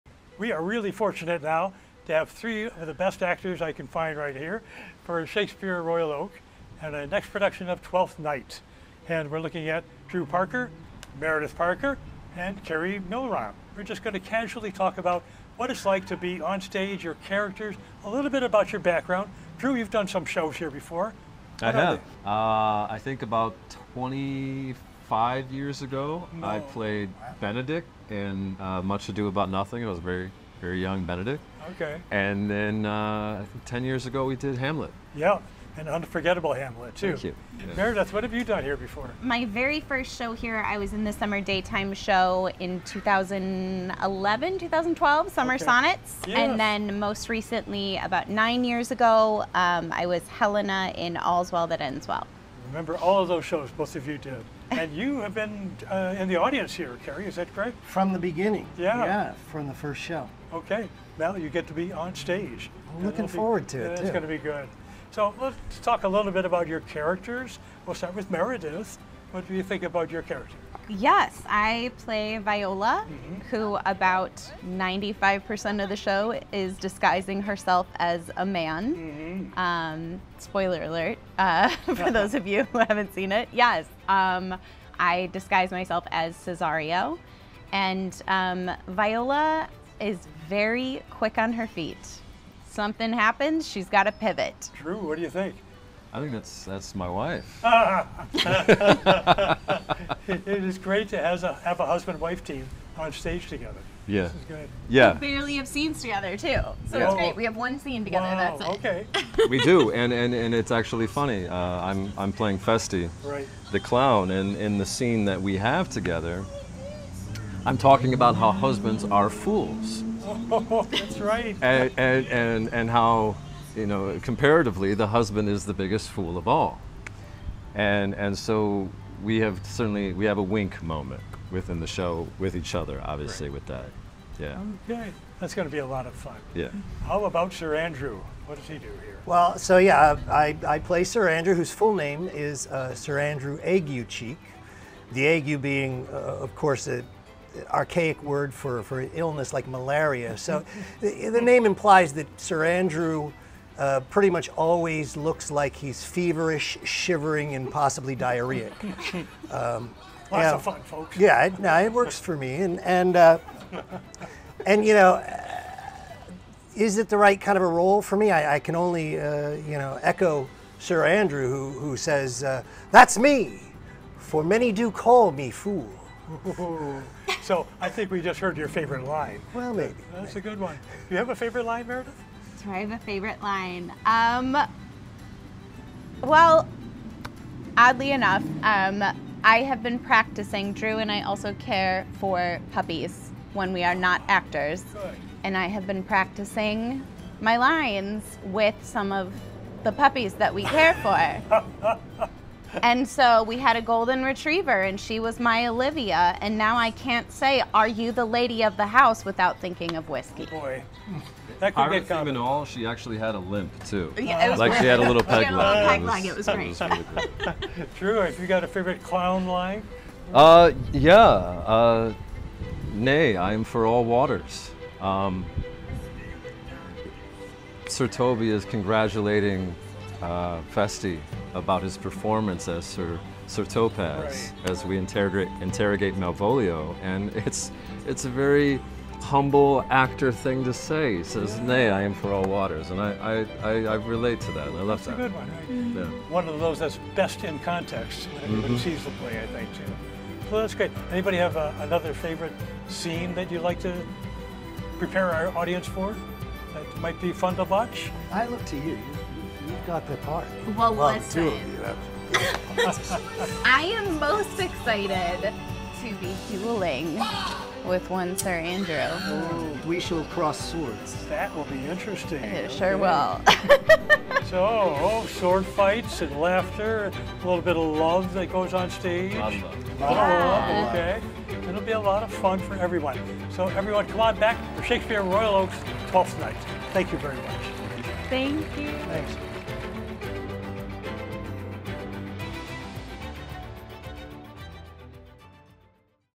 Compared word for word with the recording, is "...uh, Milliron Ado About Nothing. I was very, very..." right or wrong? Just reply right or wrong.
wrong.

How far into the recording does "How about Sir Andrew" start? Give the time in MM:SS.
02:17.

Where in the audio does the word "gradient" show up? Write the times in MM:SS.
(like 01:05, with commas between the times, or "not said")
not said.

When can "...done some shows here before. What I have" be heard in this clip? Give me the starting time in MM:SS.
00:19.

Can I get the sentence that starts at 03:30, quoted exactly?
Oh boy, that could I get all, she actually had a limp too.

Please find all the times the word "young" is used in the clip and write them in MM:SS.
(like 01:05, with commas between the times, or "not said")
00:30.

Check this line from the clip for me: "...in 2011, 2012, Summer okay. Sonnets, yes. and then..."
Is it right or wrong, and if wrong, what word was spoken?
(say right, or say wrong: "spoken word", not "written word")
right.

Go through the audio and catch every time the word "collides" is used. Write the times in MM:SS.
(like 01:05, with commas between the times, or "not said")
not said.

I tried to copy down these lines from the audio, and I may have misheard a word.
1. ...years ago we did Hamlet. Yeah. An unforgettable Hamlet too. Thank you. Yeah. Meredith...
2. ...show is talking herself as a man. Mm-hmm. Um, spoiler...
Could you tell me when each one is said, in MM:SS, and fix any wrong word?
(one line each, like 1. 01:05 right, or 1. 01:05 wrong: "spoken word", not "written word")
1. 00:33 right
2. 01:15 wrong: "disguising", not "talking".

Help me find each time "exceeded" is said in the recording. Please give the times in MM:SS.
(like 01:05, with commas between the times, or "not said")
not said.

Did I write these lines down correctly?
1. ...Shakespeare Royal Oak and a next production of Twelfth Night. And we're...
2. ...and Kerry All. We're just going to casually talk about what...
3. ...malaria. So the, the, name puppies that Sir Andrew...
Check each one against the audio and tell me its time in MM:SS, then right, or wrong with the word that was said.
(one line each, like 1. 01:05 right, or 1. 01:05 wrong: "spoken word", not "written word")
1. 00:05 right
2. 00:12 wrong: "Milliron", not "All"
3. 02:29 wrong: "implies", not "puppies".